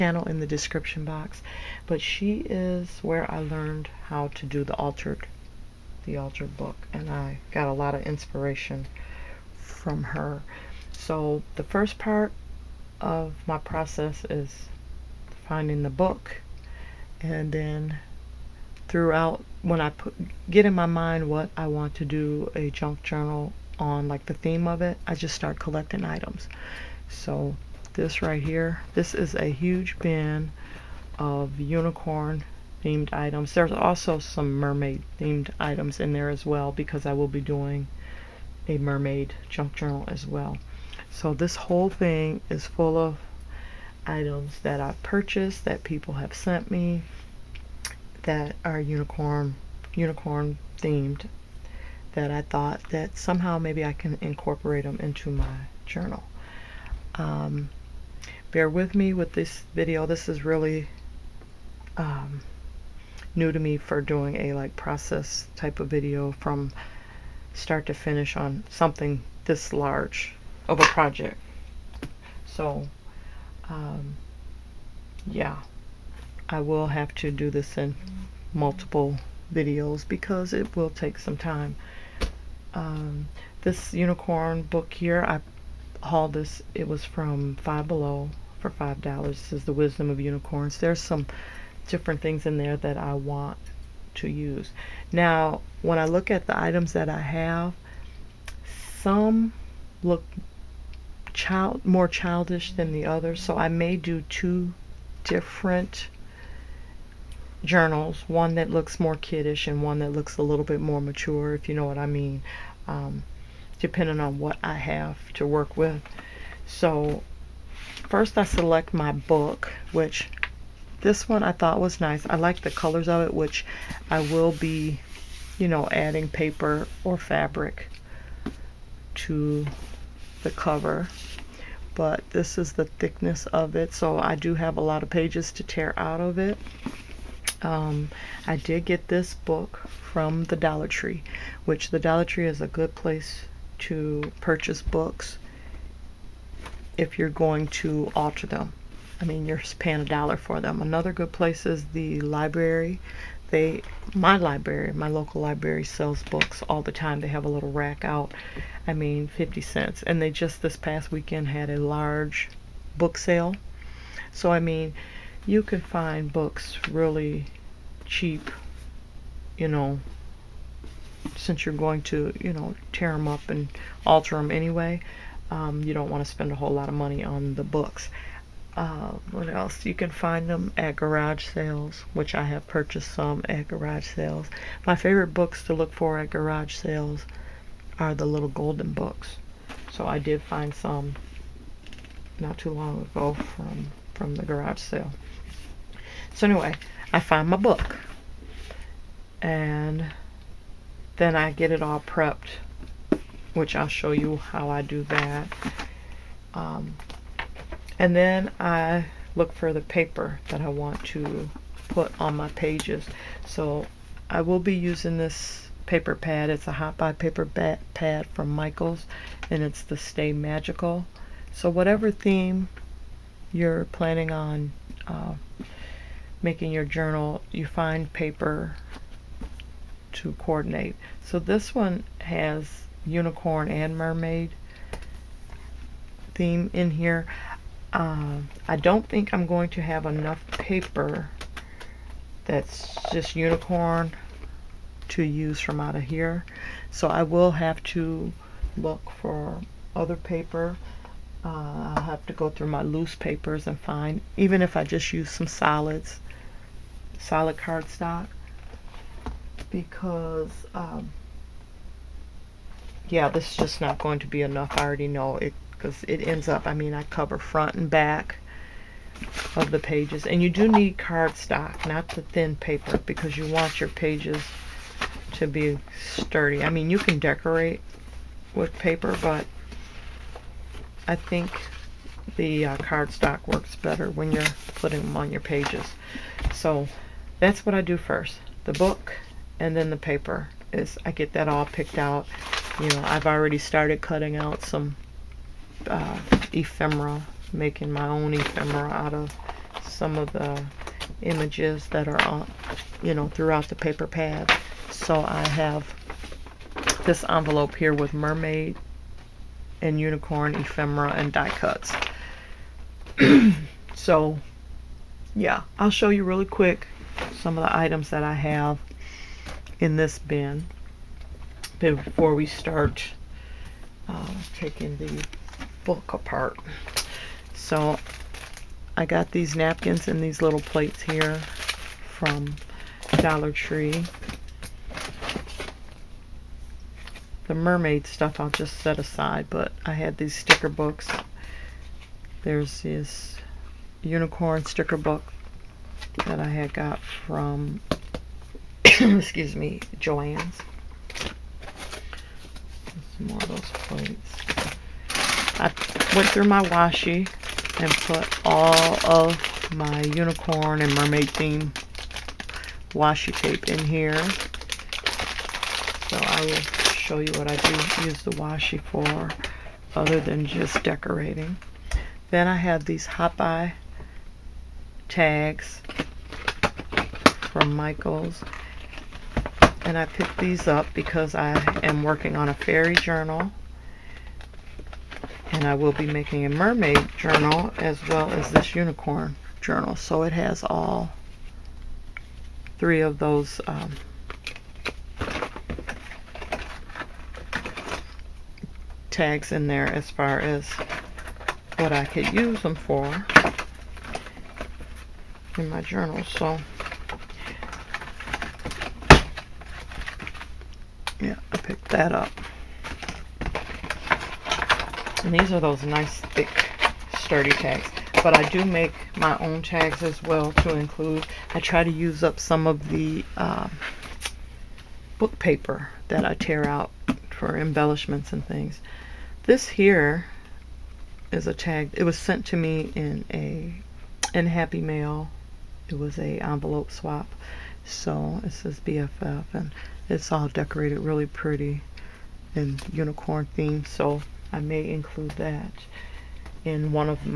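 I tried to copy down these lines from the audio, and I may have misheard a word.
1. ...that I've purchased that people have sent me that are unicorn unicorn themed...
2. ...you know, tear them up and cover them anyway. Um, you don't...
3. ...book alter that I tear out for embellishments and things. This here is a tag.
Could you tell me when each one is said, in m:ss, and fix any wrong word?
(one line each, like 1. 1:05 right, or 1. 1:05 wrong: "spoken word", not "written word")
1. 0:44 right
2. 2:52 wrong: "alter", not "cover"
3. 7:05 wrong: "paper", not "alter".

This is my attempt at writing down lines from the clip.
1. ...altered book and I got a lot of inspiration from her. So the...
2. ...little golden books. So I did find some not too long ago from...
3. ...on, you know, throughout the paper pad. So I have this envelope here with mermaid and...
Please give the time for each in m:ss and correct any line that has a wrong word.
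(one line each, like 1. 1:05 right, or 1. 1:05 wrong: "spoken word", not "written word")
1. 0:06 right
2. 3:08 right
3. 5:02 right.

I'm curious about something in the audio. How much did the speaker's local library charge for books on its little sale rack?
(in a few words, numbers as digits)
50 cents.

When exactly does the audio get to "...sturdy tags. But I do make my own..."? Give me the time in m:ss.
6:57.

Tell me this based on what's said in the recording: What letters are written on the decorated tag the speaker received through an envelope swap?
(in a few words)
BFF.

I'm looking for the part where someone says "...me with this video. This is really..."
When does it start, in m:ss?
0:58.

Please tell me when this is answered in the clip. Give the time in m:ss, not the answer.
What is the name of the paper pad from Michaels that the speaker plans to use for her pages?
3:39.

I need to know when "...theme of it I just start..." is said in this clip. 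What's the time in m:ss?
0:24.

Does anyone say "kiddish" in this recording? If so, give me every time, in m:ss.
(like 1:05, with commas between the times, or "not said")
1:49.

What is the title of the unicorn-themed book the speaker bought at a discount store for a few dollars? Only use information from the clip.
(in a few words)
The Wisdom of Unicorns.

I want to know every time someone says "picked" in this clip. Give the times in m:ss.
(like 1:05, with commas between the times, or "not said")
4:51, 6:20, 6:51.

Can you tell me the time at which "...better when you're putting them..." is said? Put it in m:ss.
4:43.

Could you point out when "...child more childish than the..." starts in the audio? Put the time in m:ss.
1:41.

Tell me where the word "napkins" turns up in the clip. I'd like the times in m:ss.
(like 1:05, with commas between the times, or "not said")
5:29.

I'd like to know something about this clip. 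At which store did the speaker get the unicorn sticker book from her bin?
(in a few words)
Joann's.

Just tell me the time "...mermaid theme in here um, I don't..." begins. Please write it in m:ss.
3:53.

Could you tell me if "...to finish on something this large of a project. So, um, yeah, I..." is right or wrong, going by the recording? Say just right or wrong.
right.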